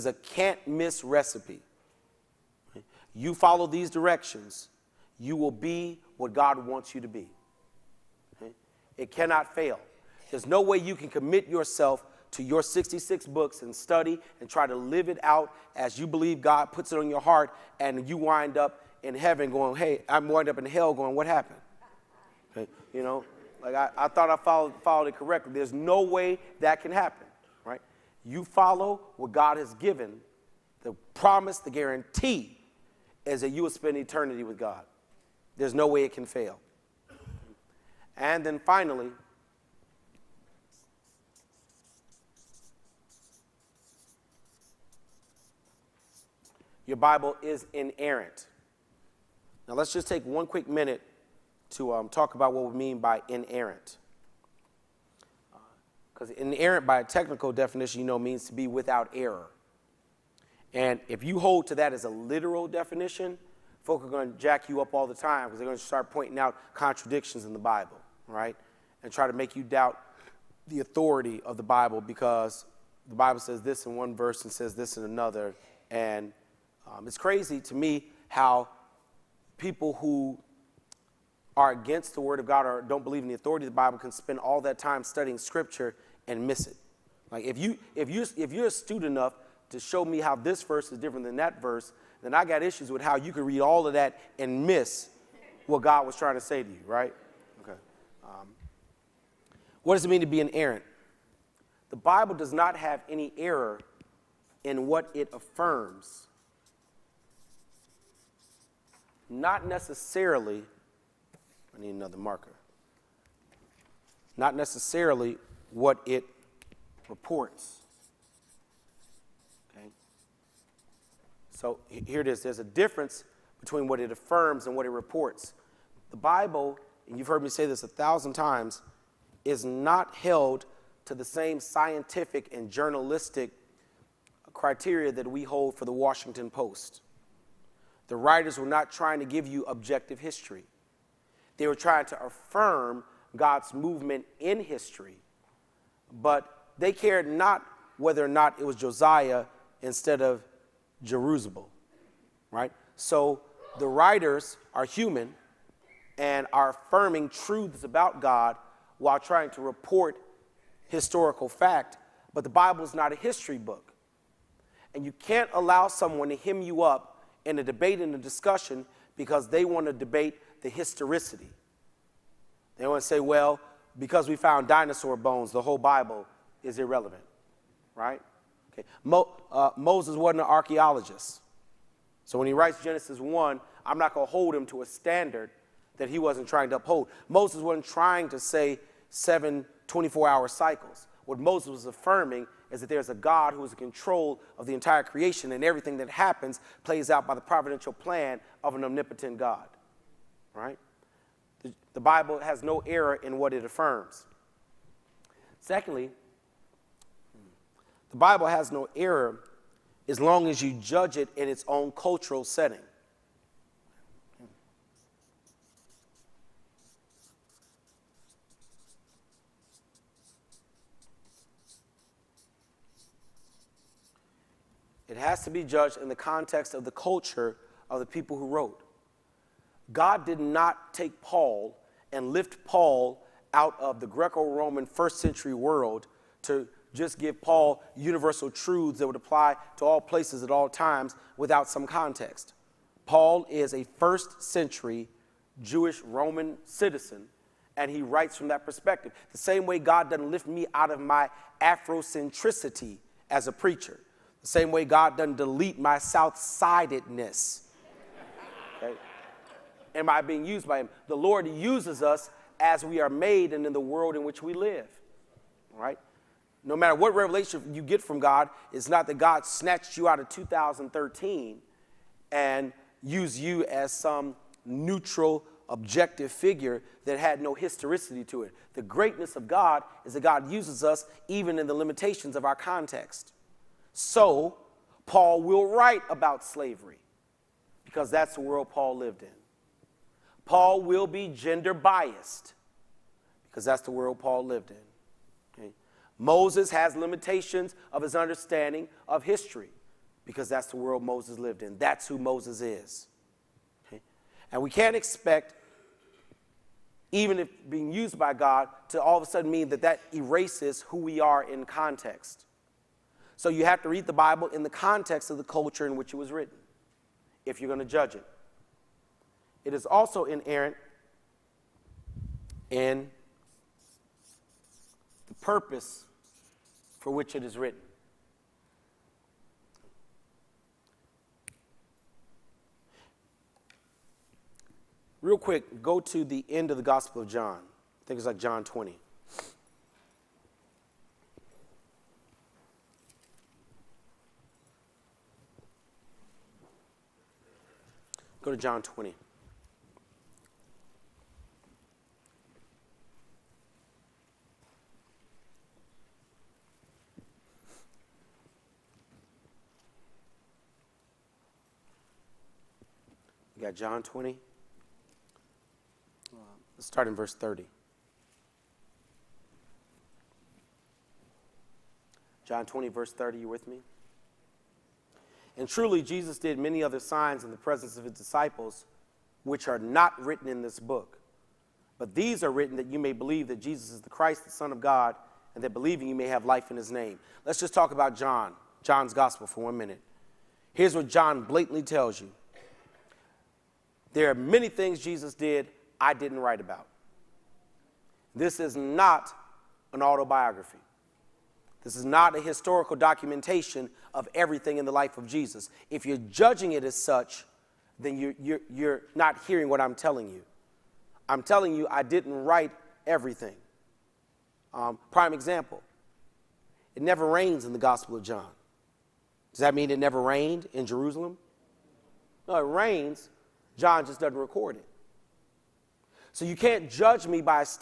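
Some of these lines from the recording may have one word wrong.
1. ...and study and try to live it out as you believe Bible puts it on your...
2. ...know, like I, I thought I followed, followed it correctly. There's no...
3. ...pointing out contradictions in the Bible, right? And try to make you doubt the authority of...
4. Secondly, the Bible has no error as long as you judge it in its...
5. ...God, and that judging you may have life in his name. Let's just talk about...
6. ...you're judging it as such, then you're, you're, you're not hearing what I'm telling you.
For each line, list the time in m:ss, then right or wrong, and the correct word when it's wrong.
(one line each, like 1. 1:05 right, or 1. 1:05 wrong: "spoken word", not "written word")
1. 0:13 wrong: "God", not "Bible"
2. 0:23 right
3. 1:06 right
4. 3:25 right
5. 6:24 wrong: "believing", not "judging"
6. 6:46 right.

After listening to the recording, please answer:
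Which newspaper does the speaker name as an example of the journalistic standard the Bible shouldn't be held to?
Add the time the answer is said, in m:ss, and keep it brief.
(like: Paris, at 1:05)
Washington Post, at 2:15.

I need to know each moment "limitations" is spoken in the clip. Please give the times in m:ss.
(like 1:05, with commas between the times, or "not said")
4:41, 4:56.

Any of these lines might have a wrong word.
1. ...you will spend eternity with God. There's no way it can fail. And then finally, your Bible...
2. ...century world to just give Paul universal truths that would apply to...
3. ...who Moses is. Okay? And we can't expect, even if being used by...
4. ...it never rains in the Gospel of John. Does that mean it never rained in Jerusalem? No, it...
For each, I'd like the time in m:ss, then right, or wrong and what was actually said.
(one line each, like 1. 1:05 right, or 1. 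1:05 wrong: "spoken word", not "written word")
1. 0:33 right
2. 3:55 right
3. 5:02 right
4. 6:56 right.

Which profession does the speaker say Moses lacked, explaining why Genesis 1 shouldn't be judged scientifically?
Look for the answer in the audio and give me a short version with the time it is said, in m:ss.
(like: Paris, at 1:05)
archaeologist, at 3:00.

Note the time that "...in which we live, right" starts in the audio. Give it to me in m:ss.
4:24.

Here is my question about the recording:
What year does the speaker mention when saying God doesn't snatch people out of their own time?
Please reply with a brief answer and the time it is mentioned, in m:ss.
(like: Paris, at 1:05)
2013, at 4:30.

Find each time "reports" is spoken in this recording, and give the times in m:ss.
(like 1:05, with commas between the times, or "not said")
1:57, 2:04, 2:39.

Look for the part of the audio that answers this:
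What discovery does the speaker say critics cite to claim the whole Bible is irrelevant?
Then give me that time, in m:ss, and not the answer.
2:54.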